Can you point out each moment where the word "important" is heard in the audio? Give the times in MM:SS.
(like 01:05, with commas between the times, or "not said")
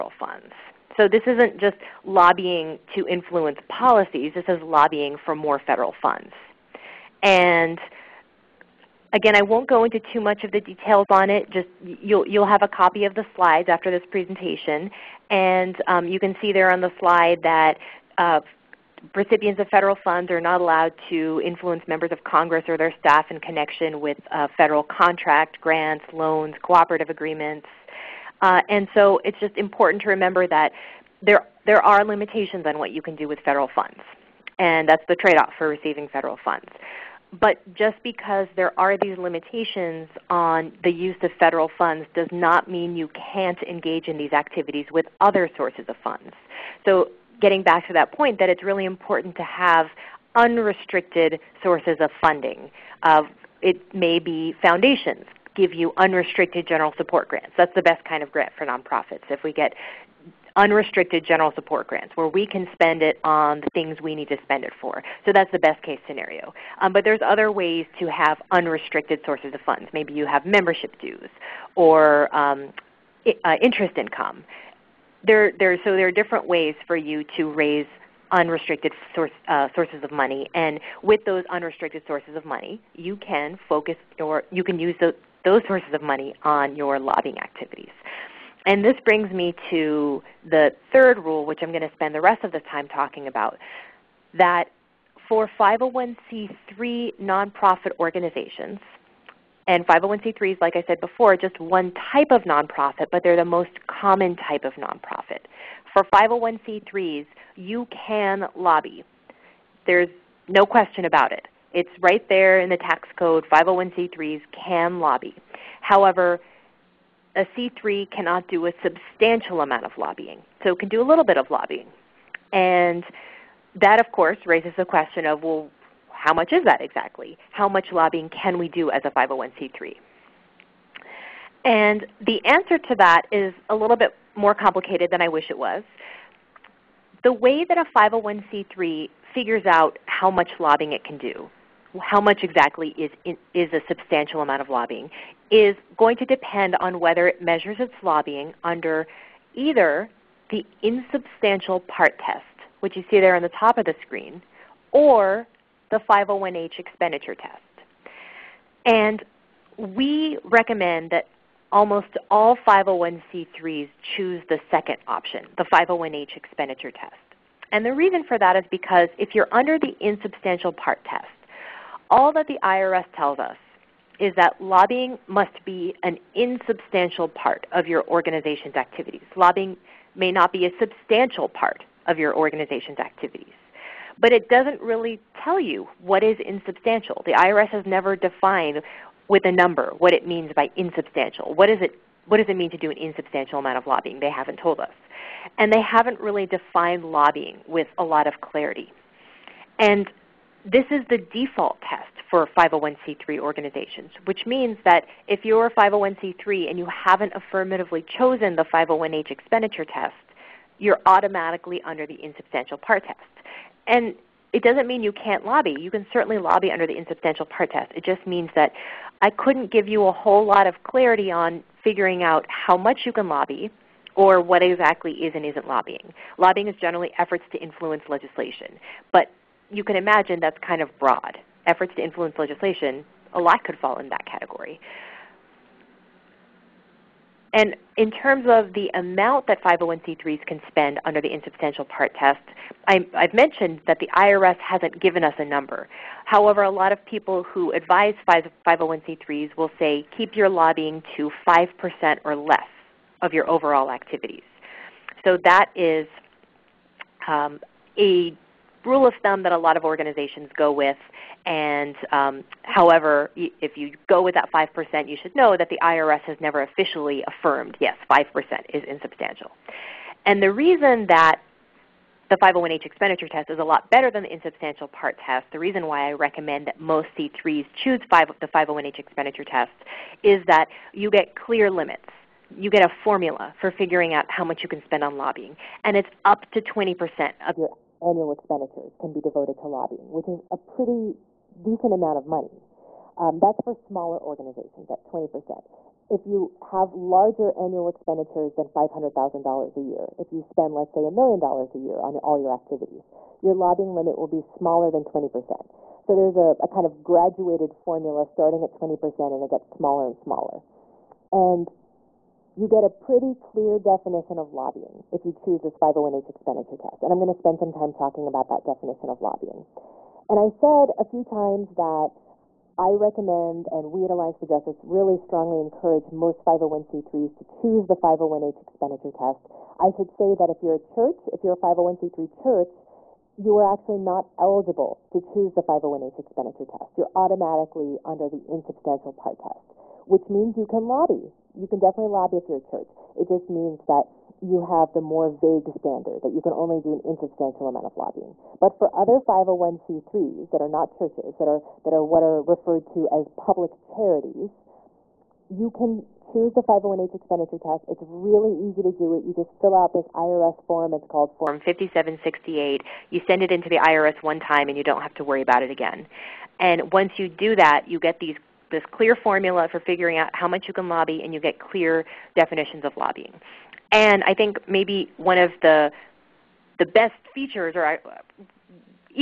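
00:29, 00:48.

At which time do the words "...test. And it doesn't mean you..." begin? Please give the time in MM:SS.
03:33.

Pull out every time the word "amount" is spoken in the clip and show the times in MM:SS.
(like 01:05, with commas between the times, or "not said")
01:59, 02:24, 03:13, 03:58, 04:51, 05:47.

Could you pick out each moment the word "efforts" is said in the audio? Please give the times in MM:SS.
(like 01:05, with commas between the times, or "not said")
03:47, 03:51.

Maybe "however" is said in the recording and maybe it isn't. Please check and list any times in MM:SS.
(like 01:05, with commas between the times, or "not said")
01:55, 04:06, 04:22.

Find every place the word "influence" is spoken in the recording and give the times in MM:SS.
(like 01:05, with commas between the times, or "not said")
00:03, 00:21, 03:47, 03:52.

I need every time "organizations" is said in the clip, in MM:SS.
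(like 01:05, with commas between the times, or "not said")
01:38, 02:58, 03:02, 03:23, 04:19, 04:54.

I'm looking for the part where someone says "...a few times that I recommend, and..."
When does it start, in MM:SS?
05:20.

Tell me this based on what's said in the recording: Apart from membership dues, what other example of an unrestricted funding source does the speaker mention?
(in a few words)
Interest income.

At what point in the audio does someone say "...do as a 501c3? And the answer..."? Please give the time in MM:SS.
02:08.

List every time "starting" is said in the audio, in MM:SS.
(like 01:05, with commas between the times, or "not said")
05:08.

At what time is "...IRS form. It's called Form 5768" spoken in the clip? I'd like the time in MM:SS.
06:00.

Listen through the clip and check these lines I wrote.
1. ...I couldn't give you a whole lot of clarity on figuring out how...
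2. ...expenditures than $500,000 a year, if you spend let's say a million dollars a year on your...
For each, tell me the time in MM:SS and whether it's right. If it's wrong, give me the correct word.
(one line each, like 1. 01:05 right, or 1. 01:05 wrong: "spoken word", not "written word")
1. 03:39 right
2. 04:57 right.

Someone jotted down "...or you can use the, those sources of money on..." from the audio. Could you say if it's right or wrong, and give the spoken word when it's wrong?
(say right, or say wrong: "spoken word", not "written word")
right.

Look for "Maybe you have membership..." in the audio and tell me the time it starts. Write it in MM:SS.
01:09.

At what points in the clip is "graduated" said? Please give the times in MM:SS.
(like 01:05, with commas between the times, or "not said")
05:07.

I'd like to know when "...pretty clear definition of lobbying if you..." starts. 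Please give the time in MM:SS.
05:12.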